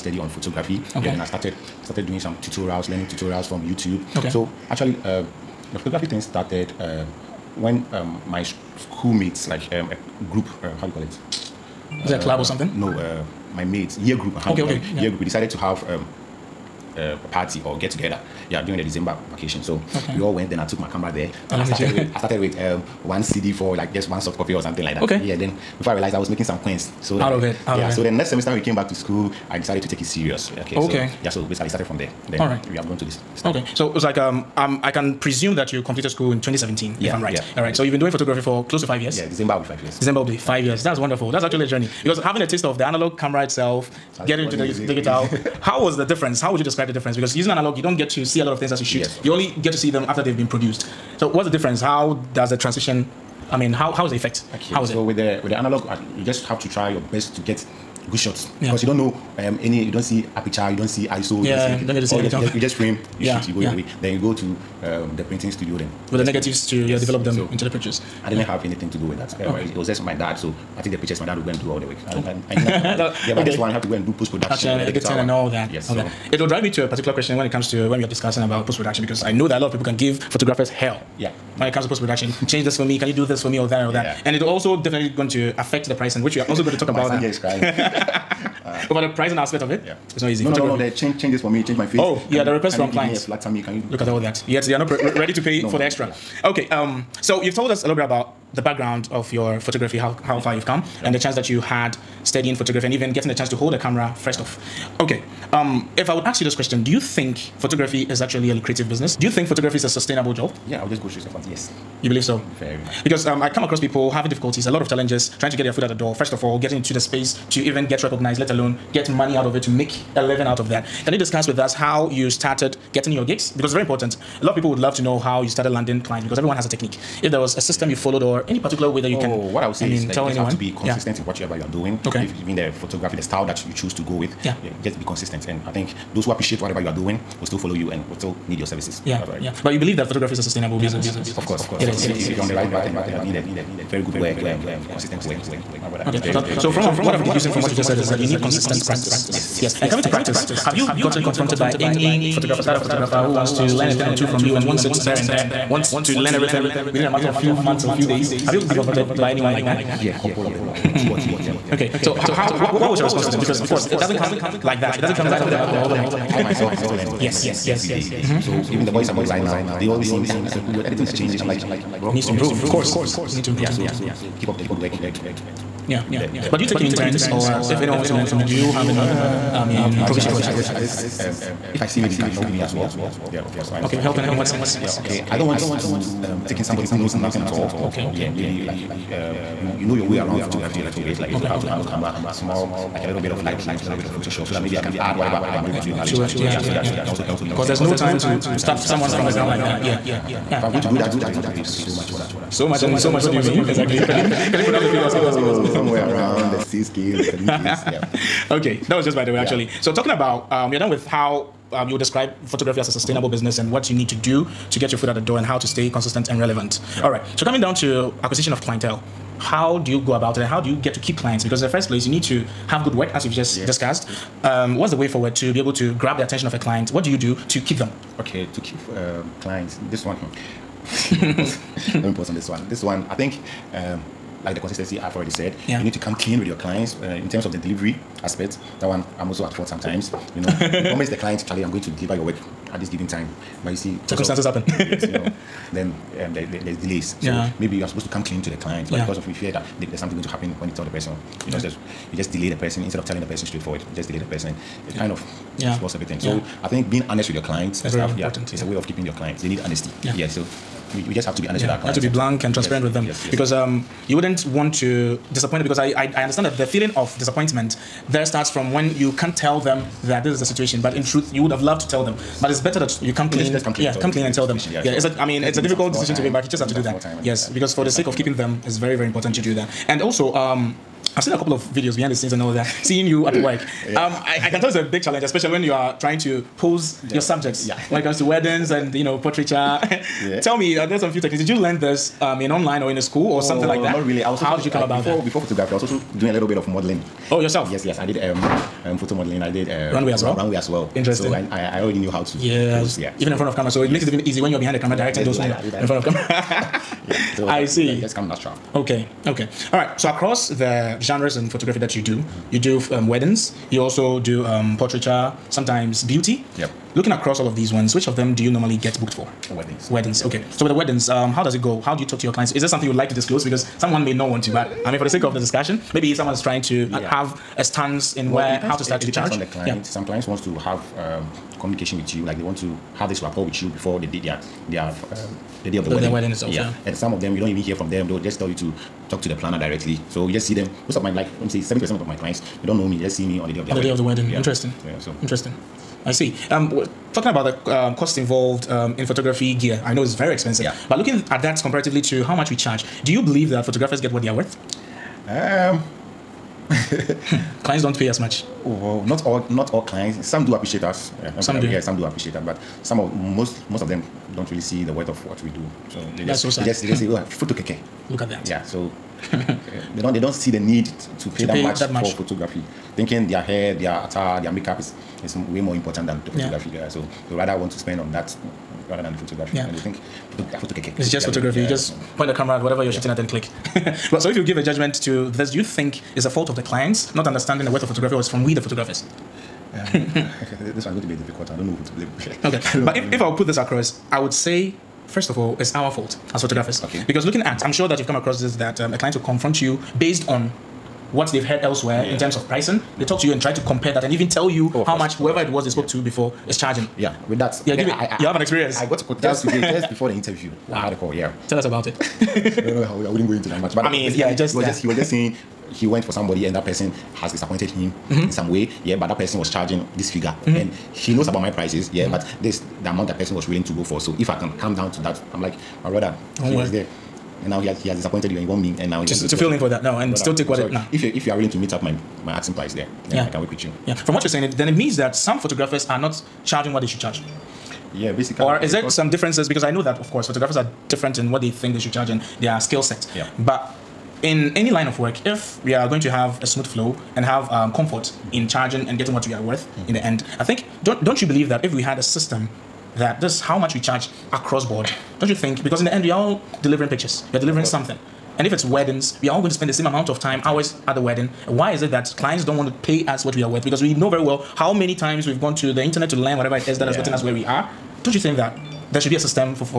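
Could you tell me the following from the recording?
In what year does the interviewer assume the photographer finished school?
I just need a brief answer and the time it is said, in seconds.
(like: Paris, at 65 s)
2017, at 36 s.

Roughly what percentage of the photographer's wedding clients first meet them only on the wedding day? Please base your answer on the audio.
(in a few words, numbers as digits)
70 percent.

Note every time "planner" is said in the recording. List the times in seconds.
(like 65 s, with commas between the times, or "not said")
339 s.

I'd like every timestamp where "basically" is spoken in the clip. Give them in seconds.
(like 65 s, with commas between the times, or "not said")
31 s, 438 s.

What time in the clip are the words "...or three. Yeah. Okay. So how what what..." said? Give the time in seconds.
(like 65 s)
161 s.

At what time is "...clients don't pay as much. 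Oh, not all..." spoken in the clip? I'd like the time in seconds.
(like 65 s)
357 s.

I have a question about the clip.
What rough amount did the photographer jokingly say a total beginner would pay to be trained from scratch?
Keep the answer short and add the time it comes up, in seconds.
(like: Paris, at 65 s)
six kids, at 206 s.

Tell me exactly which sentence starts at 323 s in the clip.
Because someone may not want to, but I mean, for the sake of the discussion, maybe someone is trying to uh, yeah.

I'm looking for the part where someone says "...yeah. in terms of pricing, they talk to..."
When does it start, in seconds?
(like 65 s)
402 s.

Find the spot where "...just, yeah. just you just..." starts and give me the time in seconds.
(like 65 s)
251 s.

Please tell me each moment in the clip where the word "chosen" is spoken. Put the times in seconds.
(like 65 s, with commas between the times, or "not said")
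not said.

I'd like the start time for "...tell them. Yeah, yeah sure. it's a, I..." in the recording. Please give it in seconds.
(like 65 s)
274 s.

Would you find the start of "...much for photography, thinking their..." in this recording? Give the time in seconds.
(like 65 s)
371 s.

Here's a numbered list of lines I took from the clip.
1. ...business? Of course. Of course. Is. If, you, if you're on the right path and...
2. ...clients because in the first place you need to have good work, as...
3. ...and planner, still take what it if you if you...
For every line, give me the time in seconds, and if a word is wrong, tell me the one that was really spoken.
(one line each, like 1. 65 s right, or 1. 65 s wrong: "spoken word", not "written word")
1. 140 s right
2. 221 s right
3. 429 s wrong: "brother", not "planner".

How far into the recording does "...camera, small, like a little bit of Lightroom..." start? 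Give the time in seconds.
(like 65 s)
191 s.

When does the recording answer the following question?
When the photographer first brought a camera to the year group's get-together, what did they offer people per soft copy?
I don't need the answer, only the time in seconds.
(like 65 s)
23 s.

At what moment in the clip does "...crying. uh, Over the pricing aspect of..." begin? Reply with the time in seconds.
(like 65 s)
87 s.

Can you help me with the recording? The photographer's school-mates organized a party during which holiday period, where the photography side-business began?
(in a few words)
December vacation.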